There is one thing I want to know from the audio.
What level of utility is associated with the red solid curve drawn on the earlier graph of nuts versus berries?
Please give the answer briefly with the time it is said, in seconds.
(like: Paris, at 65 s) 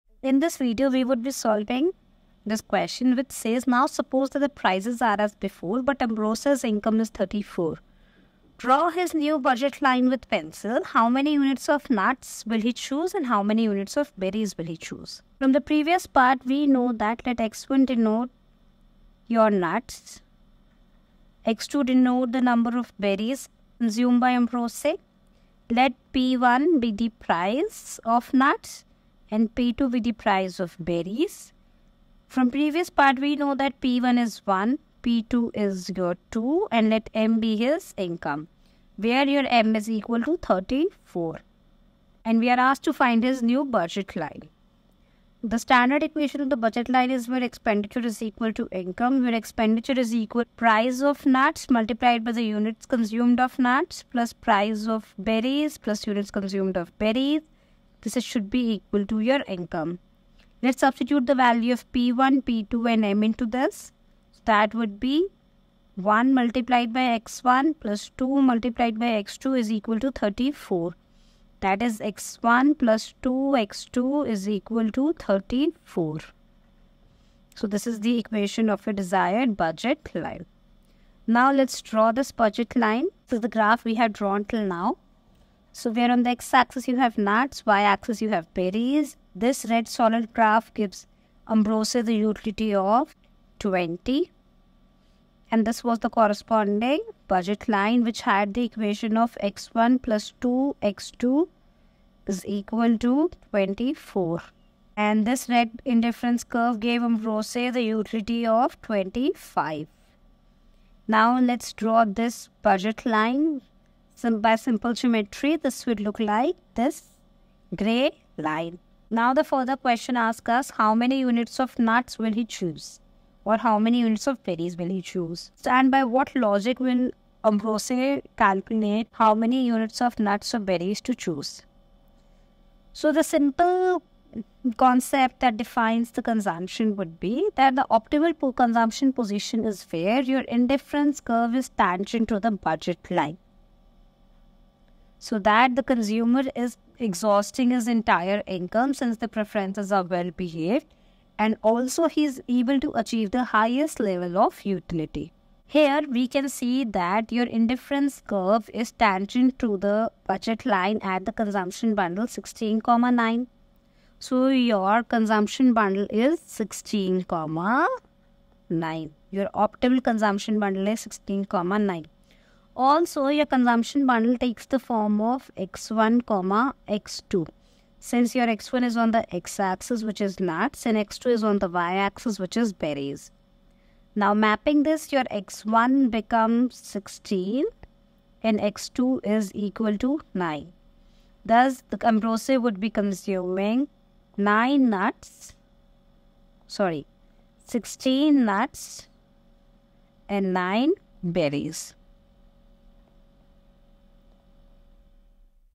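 20, at 92 s.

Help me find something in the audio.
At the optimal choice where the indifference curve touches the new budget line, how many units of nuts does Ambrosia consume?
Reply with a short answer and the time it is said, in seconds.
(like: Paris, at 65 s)
16, at 197 s.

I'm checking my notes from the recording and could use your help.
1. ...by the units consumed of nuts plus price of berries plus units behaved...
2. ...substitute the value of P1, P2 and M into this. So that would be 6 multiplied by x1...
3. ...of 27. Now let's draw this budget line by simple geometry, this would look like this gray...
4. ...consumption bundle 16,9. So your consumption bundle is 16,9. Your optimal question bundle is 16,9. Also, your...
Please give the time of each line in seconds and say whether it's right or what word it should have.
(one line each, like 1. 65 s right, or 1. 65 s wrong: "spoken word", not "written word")
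1. 52 s wrong: "consumed", not "behaved"
2. 60 s wrong: "1", not "6"
3. 108 s wrong: "25", not "27"
4. 161 s wrong: "consumption", not "question".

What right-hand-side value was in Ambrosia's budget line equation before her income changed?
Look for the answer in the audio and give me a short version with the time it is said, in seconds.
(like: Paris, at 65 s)
24, at 103 s.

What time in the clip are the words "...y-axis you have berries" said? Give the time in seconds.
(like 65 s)
87 s.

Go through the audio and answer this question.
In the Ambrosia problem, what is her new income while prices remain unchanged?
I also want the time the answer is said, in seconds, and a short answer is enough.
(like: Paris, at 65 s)
34, at 6 s.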